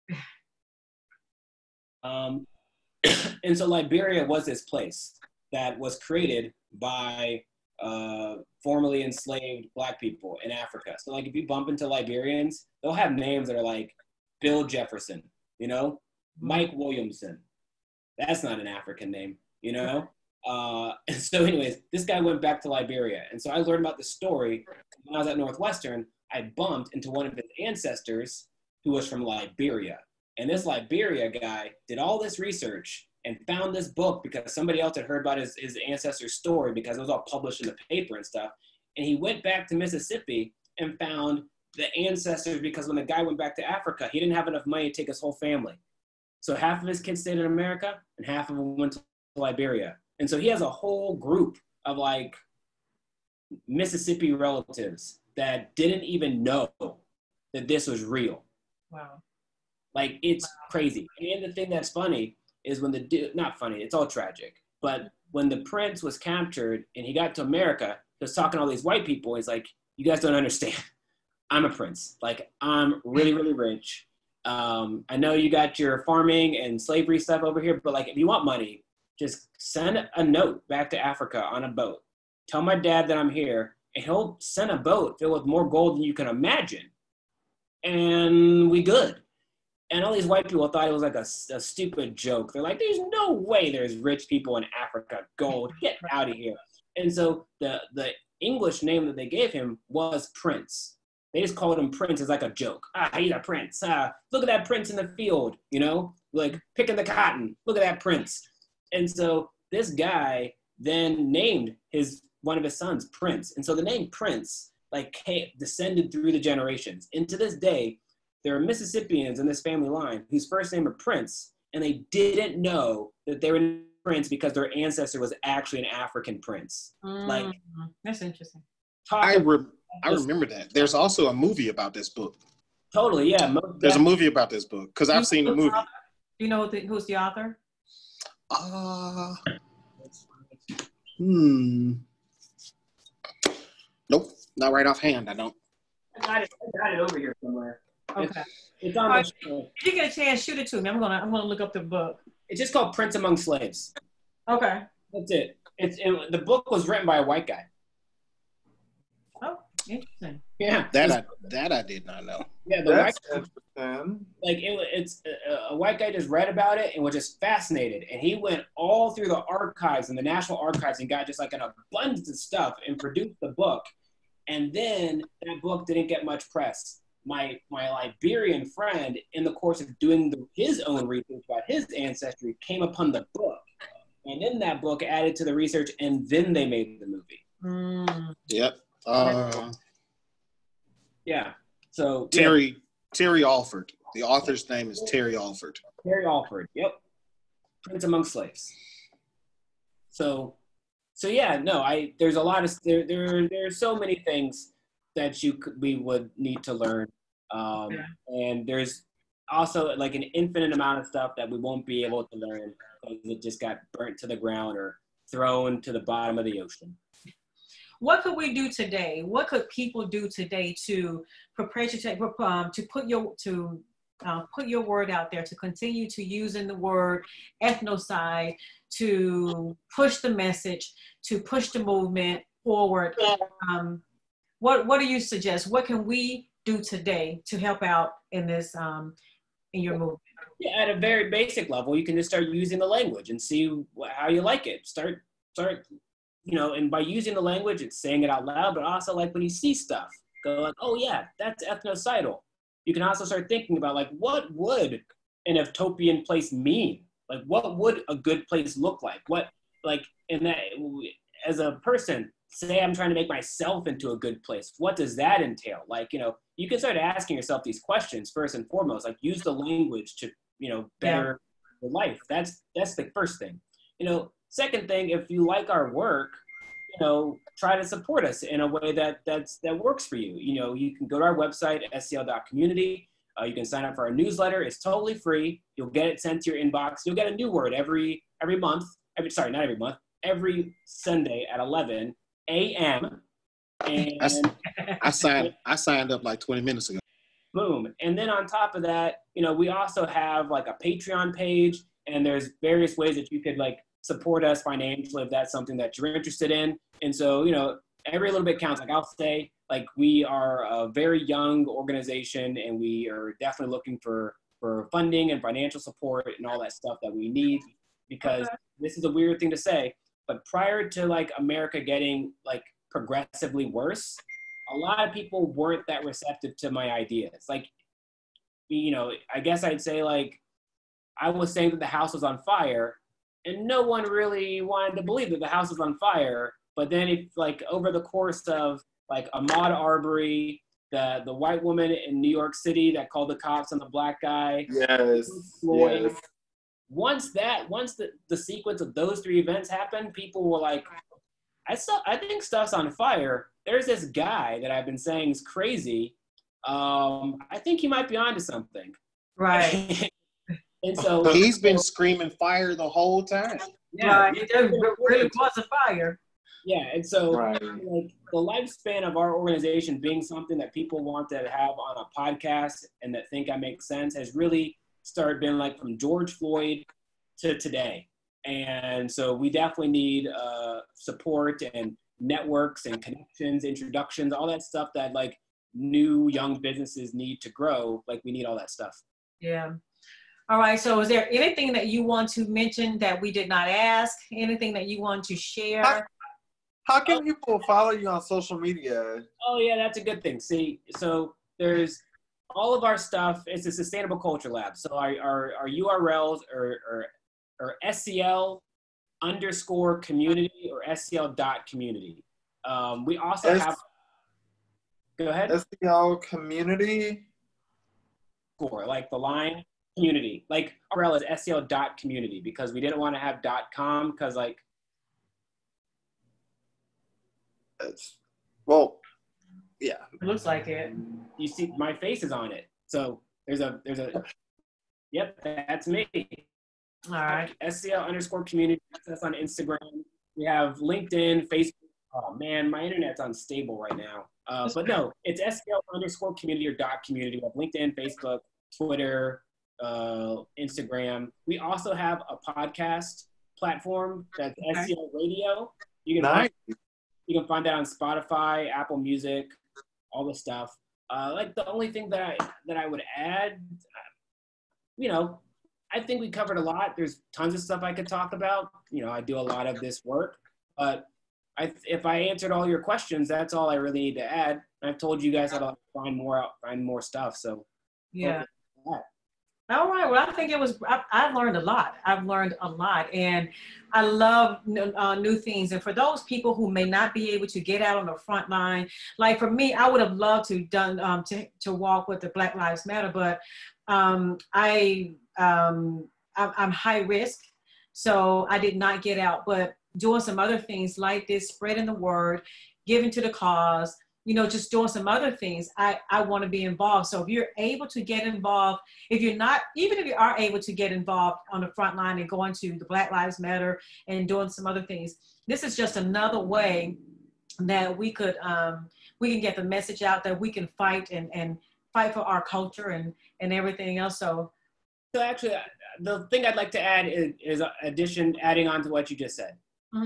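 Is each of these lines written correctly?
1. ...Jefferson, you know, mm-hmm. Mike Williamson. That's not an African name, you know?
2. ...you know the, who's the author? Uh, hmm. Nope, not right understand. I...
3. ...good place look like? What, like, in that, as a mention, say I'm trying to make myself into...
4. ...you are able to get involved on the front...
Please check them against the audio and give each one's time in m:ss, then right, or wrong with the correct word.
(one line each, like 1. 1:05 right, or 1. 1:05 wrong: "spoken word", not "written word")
1. 0:14 right
2. 2:16 wrong: "offhand", not "understand"
3. 4:18 wrong: "person", not "mention"
4. 8:30 right.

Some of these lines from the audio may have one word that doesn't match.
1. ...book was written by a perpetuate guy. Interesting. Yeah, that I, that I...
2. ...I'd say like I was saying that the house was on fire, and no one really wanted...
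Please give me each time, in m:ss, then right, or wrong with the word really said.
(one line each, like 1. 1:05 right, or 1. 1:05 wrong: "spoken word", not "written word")
1. 2:36 wrong: "white", not "perpetuate"
2. 5:29 right.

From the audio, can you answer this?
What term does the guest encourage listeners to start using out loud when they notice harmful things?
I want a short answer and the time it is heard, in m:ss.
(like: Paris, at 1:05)
ethnocidal, at 4:11.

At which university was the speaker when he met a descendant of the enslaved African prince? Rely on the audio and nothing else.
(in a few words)
Northwestern.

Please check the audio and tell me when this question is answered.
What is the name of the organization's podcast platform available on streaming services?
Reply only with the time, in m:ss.
7:34.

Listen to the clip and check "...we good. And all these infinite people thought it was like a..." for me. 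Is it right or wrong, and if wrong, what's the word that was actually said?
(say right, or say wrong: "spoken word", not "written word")
wrong: "white", not "infinite".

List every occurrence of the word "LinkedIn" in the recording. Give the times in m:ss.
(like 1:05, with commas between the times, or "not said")
7:20, 7:27.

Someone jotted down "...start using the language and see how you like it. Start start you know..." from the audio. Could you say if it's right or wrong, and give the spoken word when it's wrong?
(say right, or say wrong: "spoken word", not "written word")
right.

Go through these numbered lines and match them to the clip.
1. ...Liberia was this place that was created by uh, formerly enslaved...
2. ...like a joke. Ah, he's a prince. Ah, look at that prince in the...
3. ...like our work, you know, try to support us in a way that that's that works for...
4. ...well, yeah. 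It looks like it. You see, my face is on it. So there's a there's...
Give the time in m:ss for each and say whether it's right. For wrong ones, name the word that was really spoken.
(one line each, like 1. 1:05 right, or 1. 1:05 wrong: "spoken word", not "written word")
1. 0:03 right
2. 1:42 right
3. 4:35 right
4. 7:08 right.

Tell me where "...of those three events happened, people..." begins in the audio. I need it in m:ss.
5:48.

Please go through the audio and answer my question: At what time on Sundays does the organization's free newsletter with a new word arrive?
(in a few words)
11 a.m.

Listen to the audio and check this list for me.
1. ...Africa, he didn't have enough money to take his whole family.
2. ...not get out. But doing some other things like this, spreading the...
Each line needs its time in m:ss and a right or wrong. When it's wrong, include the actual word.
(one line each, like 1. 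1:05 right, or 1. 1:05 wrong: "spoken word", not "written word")
1. 0:43 right
2. 8:18 right.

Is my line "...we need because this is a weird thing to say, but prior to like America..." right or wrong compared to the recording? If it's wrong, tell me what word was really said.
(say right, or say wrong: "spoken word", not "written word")
right.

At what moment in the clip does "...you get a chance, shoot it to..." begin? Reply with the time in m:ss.
2:29.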